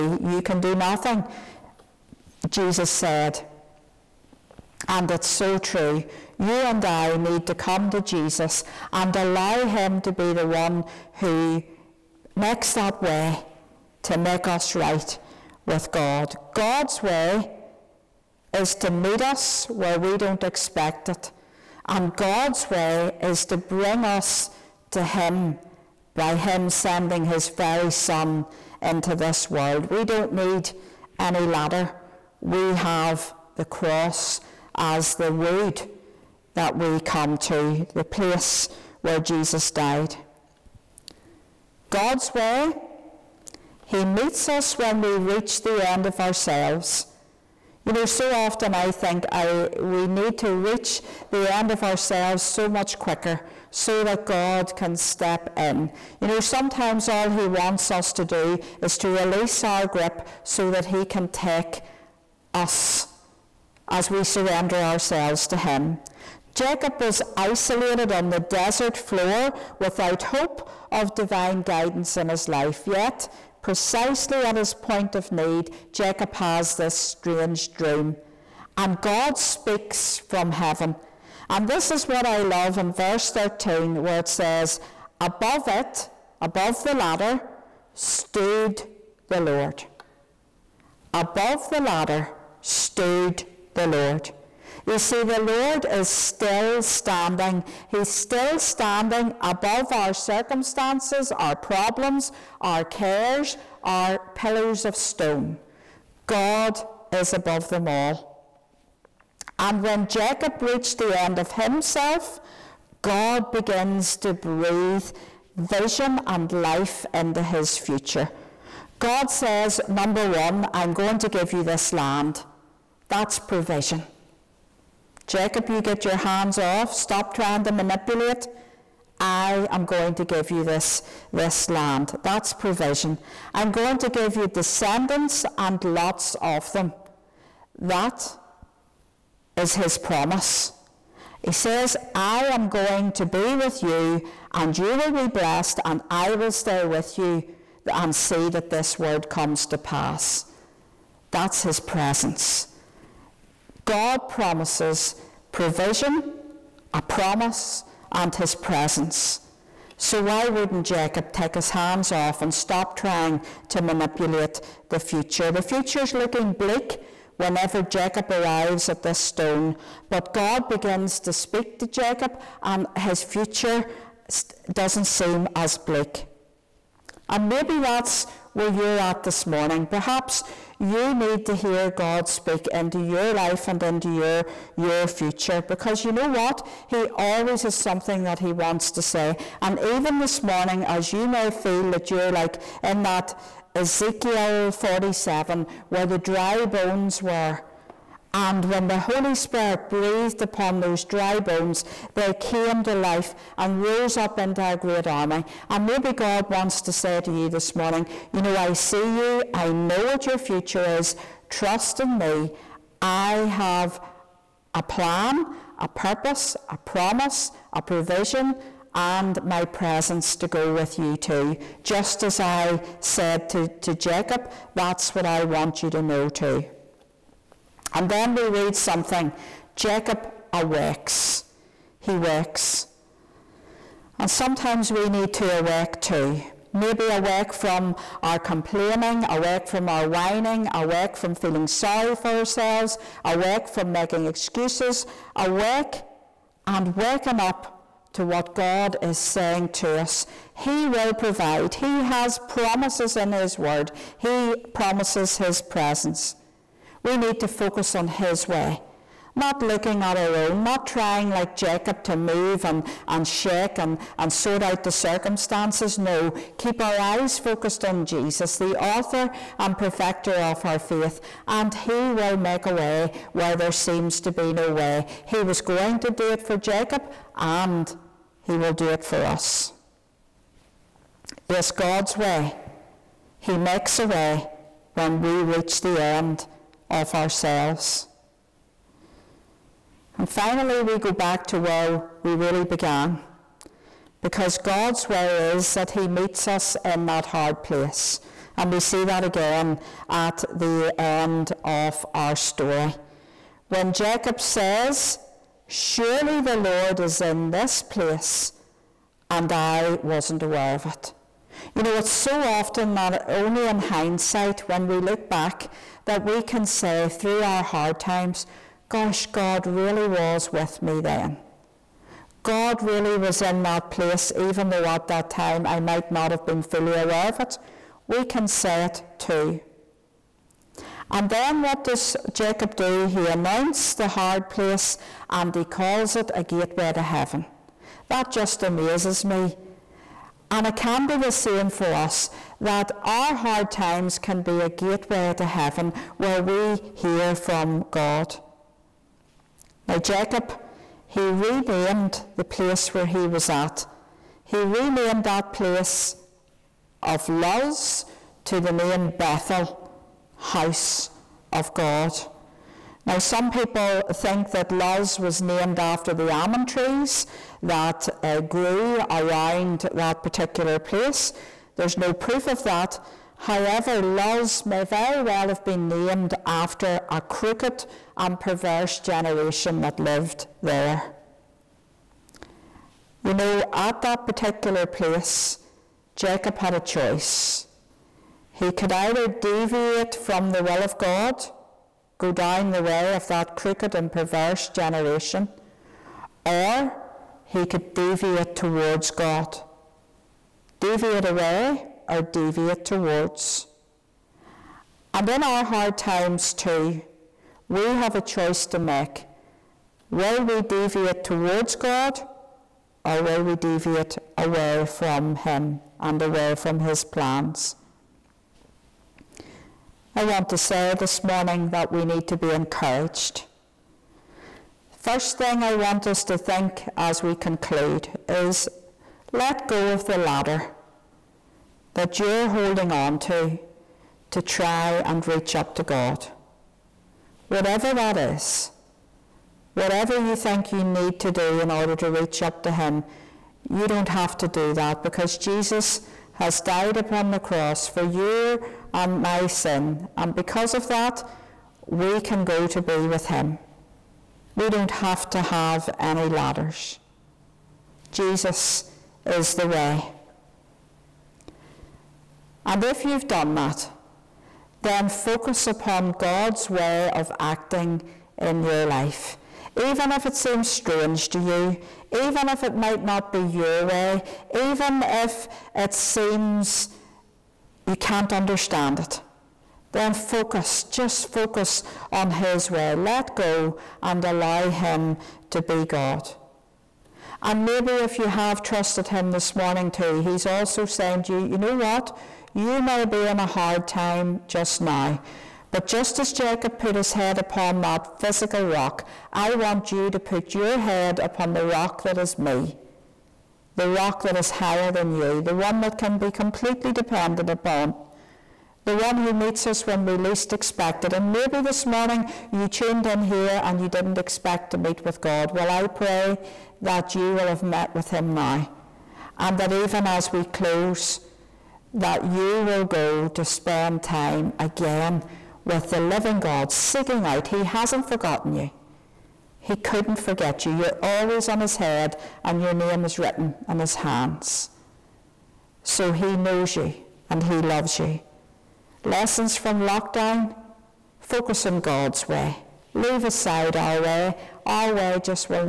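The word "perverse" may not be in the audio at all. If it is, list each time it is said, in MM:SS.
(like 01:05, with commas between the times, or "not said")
06:18, 06:34.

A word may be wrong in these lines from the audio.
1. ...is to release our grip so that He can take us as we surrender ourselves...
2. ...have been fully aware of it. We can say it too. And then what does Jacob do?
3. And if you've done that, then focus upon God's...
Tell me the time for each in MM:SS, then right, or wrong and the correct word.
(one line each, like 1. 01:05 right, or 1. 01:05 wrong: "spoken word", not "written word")
1. 00:58 right
2. 05:26 right
3. 07:42 right.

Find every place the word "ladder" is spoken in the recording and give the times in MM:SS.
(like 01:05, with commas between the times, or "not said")
00:31, 01:26, 01:31, 07:10, 07:36.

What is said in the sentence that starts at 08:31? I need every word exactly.
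And maybe this morning you tuned in here and you didn't expect to meet with God.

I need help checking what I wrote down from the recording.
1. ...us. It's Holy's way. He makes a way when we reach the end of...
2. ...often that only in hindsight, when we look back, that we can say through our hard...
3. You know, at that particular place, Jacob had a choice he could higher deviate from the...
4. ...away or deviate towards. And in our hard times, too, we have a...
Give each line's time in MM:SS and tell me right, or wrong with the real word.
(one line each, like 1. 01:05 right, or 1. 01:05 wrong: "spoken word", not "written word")
1. 04:39 wrong: "God", not "Holy"
2. 05:12 right
3. 06:23 wrong: "either", not "higher"
4. 06:41 right.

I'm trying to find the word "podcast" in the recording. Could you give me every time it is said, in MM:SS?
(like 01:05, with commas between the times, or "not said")
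not said.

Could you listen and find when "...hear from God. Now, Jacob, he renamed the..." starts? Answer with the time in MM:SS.
05:46.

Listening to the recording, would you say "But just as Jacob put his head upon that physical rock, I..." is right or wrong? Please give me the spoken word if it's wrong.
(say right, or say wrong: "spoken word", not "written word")
right.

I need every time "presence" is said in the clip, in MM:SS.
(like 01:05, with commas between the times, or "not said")
02:31, 02:38, 03:39, 04:15.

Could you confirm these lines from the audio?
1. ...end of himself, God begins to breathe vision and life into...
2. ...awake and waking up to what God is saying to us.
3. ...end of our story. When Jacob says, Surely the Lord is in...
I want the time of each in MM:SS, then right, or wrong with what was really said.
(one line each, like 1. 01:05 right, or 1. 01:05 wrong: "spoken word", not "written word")
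1. 01:51 right
2. 04:05 right
3. 05:00 right.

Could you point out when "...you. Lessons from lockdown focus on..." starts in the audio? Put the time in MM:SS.
08:57.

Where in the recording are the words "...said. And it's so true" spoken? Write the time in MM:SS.
00:02.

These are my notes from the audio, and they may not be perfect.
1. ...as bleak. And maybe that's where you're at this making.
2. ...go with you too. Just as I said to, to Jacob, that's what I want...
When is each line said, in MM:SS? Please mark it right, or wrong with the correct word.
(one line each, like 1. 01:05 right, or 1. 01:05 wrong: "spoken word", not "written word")
1. 02:55 wrong: "morning", not "making"
2. 03:40 right.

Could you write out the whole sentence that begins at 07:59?
Then focus, just focus on His way.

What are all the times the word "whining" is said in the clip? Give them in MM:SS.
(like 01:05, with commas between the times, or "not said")
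04:00.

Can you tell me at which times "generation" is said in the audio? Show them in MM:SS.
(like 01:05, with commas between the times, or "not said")
06:19, 06:34.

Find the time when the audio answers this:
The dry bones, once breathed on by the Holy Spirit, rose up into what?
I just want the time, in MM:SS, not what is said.
03:24.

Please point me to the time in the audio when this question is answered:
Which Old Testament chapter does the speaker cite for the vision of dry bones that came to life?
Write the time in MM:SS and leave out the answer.
03:13.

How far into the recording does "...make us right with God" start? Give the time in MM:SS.
00:14.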